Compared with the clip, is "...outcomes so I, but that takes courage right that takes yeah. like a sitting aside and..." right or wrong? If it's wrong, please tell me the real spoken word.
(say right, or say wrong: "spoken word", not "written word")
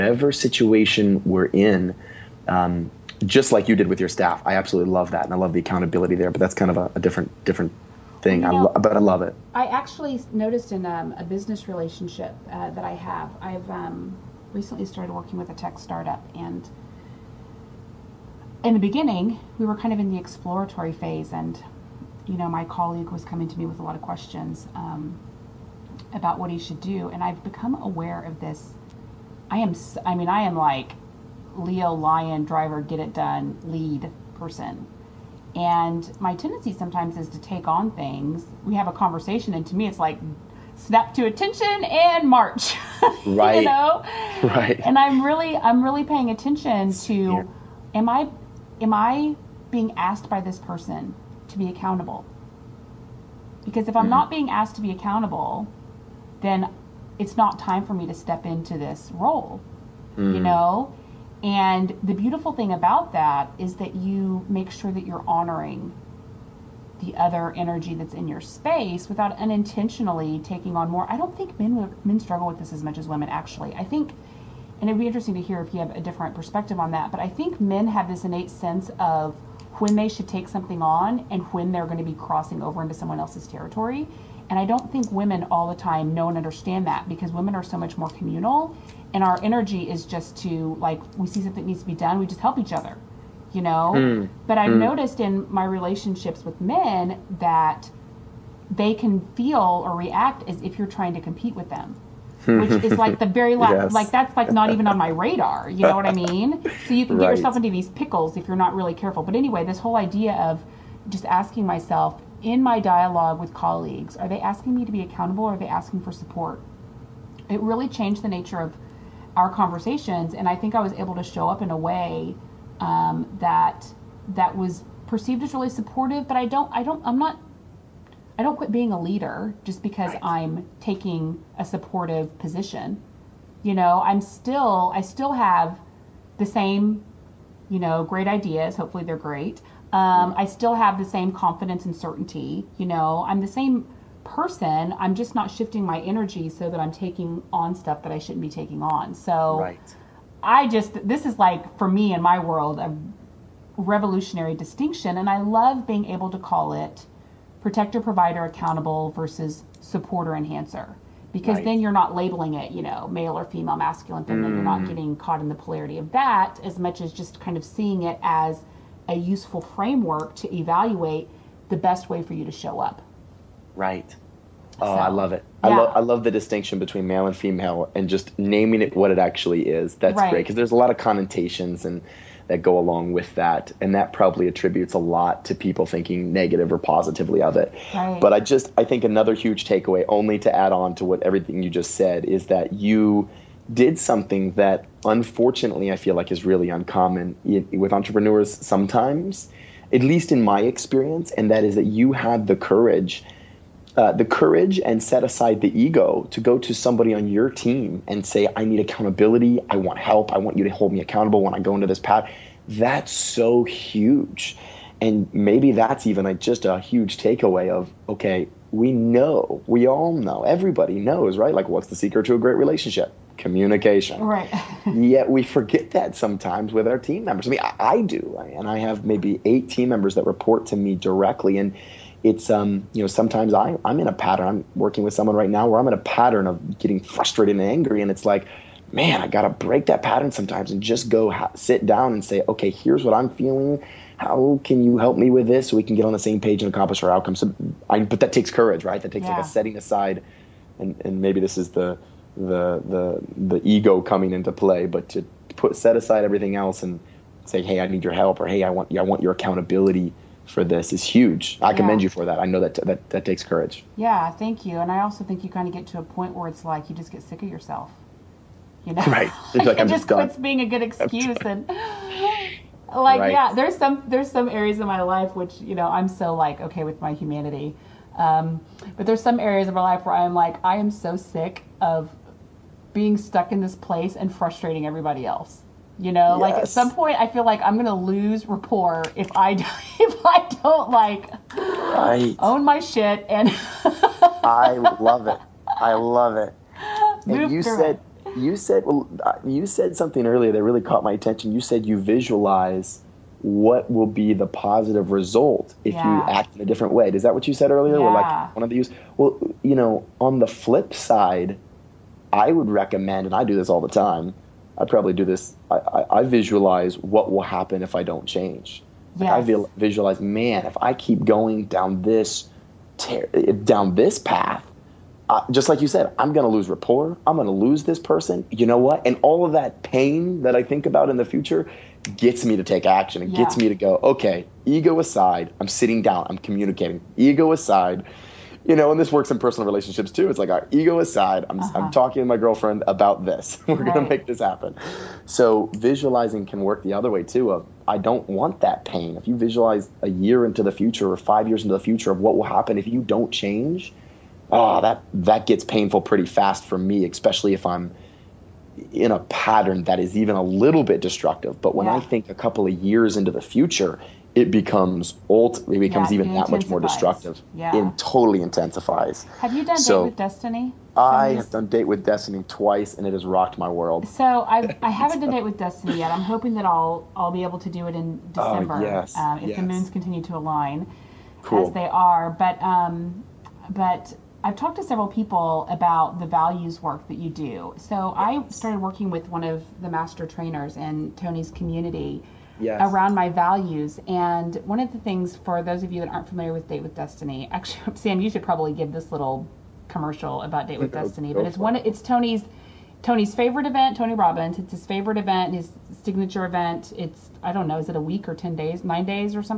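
wrong: "setting", not "sitting".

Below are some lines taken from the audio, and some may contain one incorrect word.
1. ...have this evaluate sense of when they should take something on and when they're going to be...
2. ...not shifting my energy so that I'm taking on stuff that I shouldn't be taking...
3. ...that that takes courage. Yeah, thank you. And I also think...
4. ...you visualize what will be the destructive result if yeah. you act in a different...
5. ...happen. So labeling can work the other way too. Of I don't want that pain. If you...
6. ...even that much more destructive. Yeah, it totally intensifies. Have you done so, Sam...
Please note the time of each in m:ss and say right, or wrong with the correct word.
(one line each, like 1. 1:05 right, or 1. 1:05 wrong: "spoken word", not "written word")
1. 1:17 wrong: "innate", not "evaluate"
2. 2:25 right
3. 4:22 right
4. 5:01 wrong: "positive", not "destructive"
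5. 5:44 wrong: "visualizing", not "labeling"
6. 6:06 wrong: "Date", not "Sam".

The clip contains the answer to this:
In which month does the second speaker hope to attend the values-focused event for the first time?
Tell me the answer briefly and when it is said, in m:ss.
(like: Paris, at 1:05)
December, at 6:18.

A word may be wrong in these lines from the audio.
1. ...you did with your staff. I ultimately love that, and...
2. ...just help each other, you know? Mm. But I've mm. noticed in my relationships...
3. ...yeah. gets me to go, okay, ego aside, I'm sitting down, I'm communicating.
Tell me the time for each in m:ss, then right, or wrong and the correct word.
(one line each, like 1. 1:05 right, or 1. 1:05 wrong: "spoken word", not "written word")
1. 0:03 wrong: "absolutely", not "ultimately"
2. 1:32 right
3. 5:33 right.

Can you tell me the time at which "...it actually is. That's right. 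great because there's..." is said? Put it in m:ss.
2:59.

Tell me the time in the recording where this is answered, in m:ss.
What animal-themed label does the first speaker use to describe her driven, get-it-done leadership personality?
0:31.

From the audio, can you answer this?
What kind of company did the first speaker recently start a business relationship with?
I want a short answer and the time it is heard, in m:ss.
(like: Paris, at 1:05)
Tech startup, at 0:15.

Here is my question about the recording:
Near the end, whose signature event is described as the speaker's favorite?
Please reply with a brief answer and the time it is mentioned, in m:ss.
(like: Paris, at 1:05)
Tony Robbins, at 6:43.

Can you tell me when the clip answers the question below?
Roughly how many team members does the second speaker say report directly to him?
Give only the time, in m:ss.
3:49.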